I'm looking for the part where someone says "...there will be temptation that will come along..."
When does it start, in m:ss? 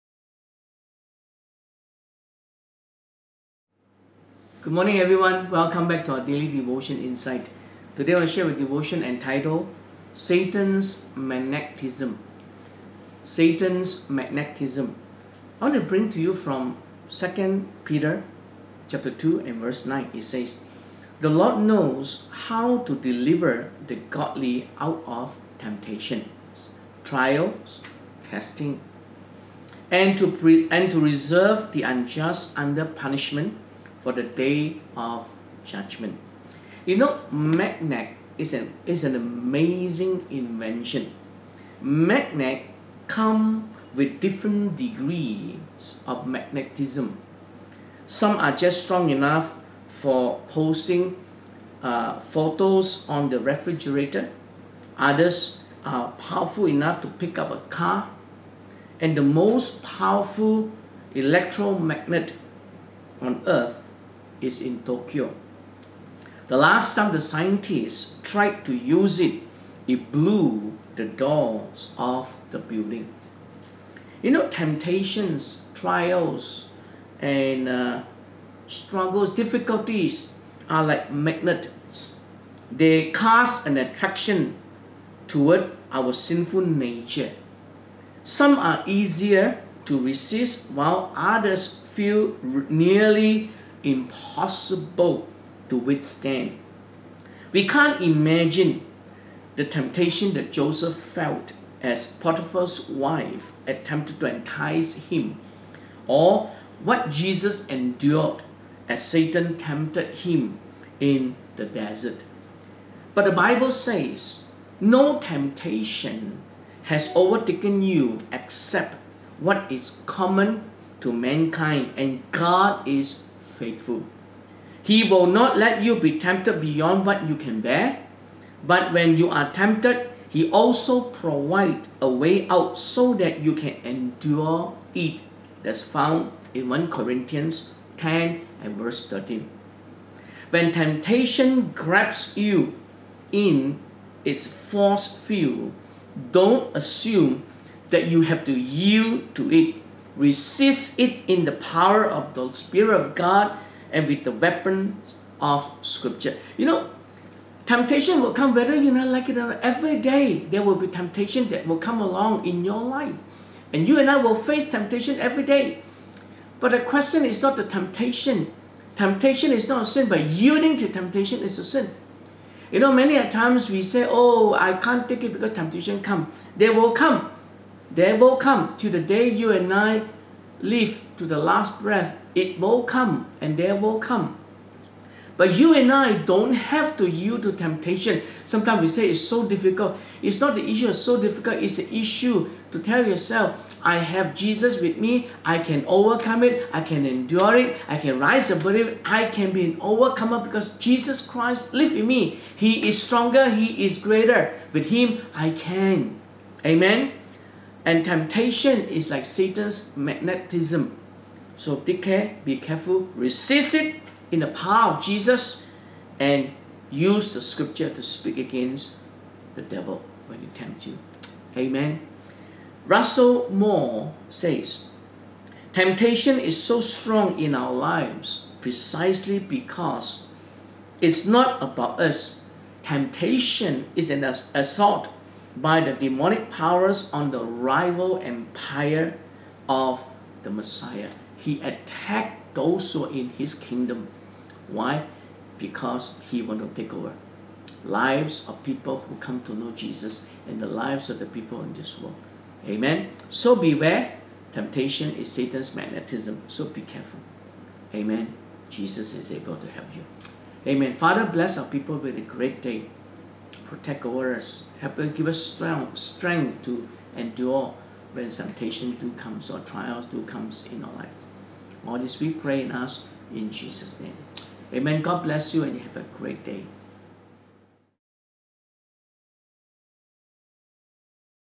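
2:40.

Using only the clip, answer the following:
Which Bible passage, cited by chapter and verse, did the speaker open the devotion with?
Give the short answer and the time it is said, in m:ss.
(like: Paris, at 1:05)
2 Peter 2:9, at 0:17.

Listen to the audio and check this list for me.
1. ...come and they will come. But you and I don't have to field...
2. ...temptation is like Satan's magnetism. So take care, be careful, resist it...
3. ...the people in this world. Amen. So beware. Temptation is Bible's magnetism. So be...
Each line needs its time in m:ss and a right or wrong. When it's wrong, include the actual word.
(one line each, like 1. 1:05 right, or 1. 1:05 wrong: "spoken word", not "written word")
1. 3:02 wrong: "yield", not "field"
2. 3:28 right
3. 4:11 wrong: "Satan", not "Bible".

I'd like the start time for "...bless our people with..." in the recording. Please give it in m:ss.
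4:21.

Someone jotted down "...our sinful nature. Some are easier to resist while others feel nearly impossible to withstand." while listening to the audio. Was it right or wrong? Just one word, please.
right.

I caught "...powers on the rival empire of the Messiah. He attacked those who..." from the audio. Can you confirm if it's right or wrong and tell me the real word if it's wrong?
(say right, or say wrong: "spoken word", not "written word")
right.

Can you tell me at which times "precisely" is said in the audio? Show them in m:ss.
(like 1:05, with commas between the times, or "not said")
3:48.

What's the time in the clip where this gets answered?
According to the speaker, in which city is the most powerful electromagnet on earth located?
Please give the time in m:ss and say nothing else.
1:04.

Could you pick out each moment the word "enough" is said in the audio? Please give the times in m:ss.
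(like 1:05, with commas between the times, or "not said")
0:49, 0:56.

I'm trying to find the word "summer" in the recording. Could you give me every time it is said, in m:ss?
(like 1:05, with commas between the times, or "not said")
not said.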